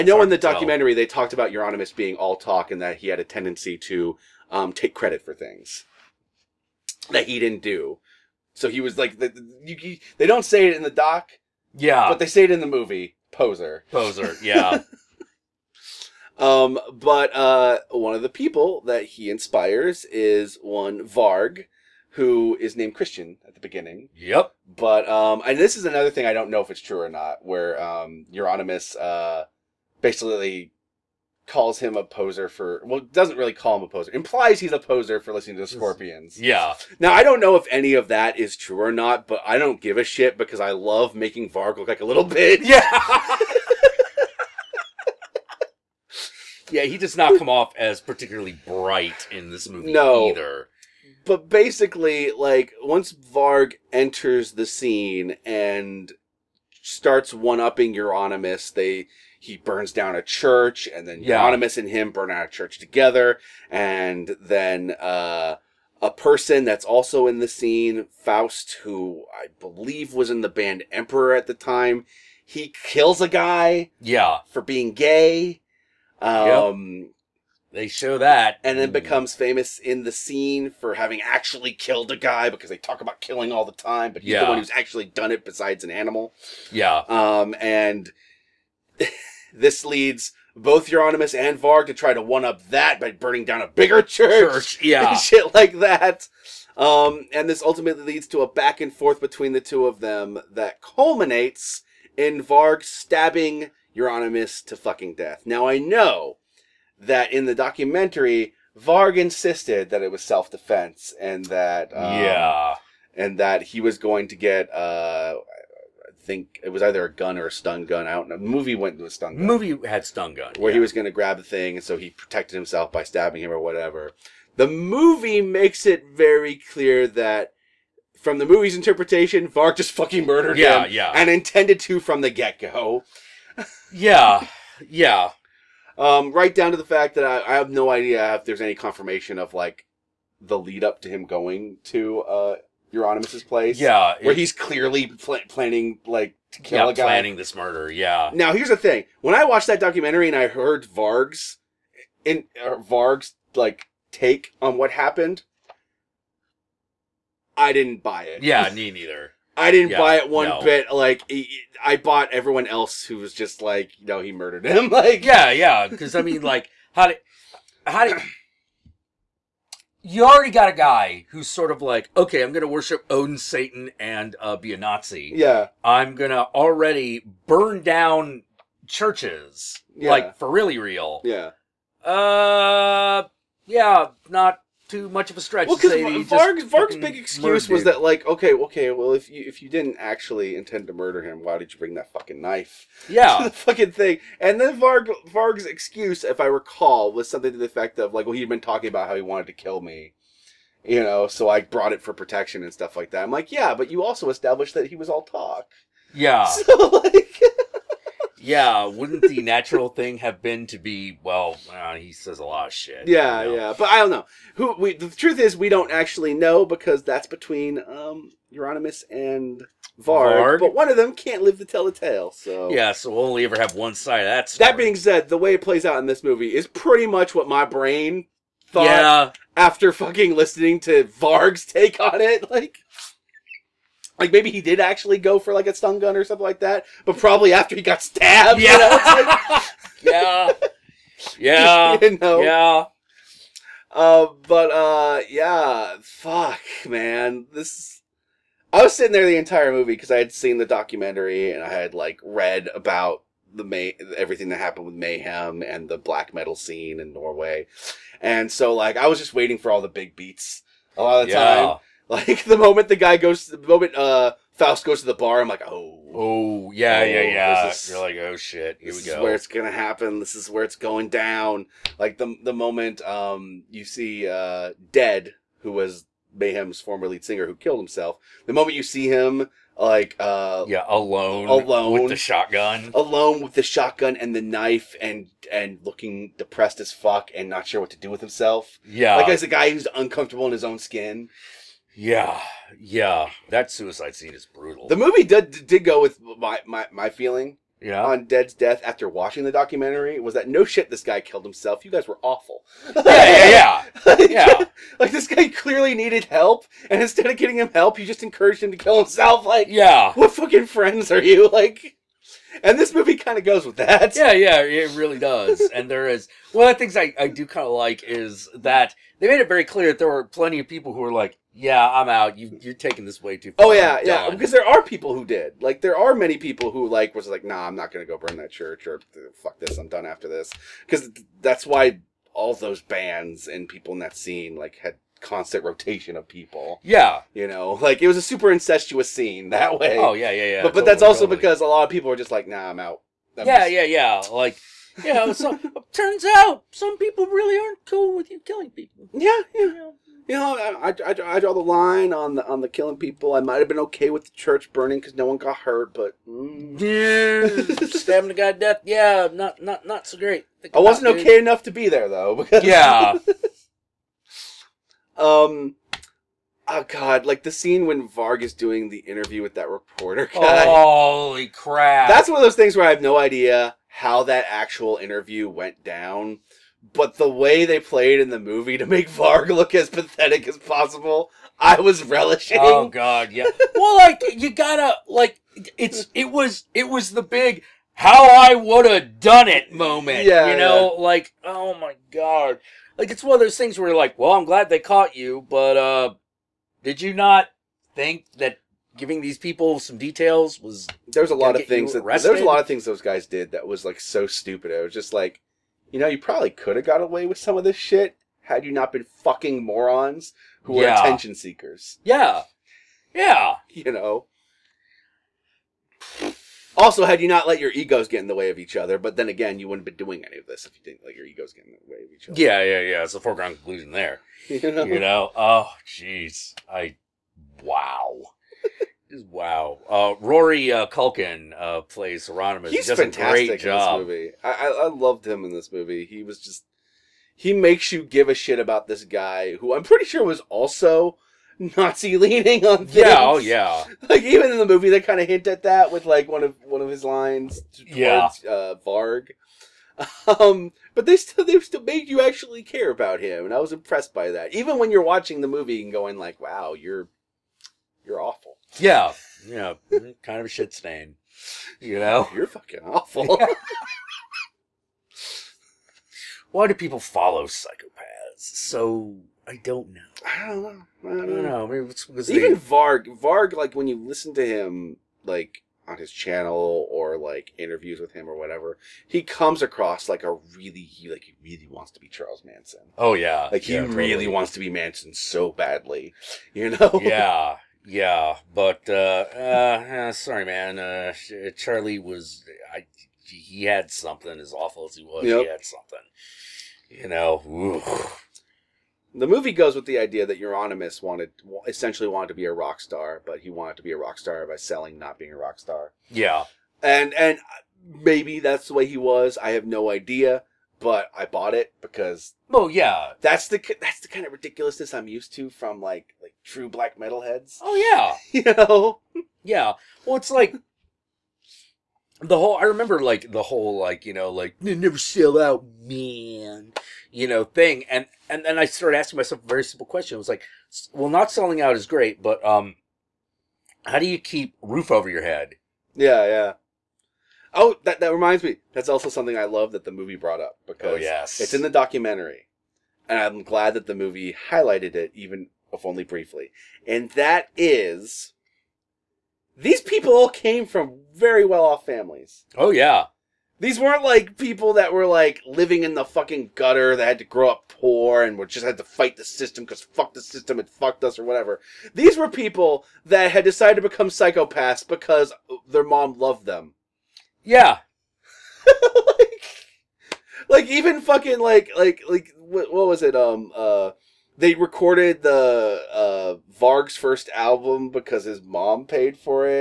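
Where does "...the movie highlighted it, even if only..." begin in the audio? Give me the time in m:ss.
9:03.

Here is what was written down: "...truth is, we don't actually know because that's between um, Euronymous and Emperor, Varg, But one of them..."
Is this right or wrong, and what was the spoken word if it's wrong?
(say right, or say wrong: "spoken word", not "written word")
wrong: "Varg", not "Emperor".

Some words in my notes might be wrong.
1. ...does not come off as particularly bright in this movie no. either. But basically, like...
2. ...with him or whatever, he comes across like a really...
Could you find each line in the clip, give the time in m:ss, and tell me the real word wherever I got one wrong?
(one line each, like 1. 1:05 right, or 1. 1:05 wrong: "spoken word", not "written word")
1. 0:46 right
2. 7:57 right.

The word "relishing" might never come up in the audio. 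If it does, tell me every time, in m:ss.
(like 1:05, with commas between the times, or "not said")
6:22.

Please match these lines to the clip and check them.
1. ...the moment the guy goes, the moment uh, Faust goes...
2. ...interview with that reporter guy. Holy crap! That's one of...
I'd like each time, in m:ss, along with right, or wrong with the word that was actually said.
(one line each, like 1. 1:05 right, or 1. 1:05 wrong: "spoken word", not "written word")
1. 4:22 right
2. 6:08 right.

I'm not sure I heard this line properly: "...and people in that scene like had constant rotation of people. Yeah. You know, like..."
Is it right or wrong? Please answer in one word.
right.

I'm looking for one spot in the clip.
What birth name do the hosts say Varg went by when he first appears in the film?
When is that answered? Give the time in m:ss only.
0:22.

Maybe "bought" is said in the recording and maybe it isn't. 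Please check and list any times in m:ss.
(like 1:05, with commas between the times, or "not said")
2:41, 8:31.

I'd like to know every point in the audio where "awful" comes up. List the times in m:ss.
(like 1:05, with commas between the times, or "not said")
5:02, 7:38, 7:42, 8:14.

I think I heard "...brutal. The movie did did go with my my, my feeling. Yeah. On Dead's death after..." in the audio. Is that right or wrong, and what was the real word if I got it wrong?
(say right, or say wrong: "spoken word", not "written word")
right.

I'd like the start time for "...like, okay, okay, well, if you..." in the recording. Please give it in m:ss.
3:08.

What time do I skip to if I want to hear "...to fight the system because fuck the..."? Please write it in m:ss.
9:18.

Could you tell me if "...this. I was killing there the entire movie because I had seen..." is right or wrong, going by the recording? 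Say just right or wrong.
wrong.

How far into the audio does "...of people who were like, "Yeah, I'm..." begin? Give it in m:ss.
5:20.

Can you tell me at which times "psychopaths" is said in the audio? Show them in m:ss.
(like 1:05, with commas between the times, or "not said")
7:47, 9:24.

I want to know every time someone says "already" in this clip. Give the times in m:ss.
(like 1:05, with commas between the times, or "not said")
2:50, 2:56.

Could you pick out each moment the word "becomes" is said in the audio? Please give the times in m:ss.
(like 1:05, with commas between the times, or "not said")
1:18, 9:23.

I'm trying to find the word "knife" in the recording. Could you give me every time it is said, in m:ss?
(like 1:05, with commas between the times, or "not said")
3:12, 4:44.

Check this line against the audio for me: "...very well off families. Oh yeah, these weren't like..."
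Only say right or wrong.
right.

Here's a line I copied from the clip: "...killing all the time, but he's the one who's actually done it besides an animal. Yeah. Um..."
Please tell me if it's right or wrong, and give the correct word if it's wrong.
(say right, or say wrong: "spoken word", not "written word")
right.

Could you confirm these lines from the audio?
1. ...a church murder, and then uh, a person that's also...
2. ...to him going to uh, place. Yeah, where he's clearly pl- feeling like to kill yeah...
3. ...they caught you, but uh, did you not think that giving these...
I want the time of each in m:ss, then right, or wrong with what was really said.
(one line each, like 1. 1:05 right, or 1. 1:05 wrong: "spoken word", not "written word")
1. 1:02 wrong: "together", not "murder"
2. 2:21 wrong: "planning", not "feeling"
3. 6:34 right.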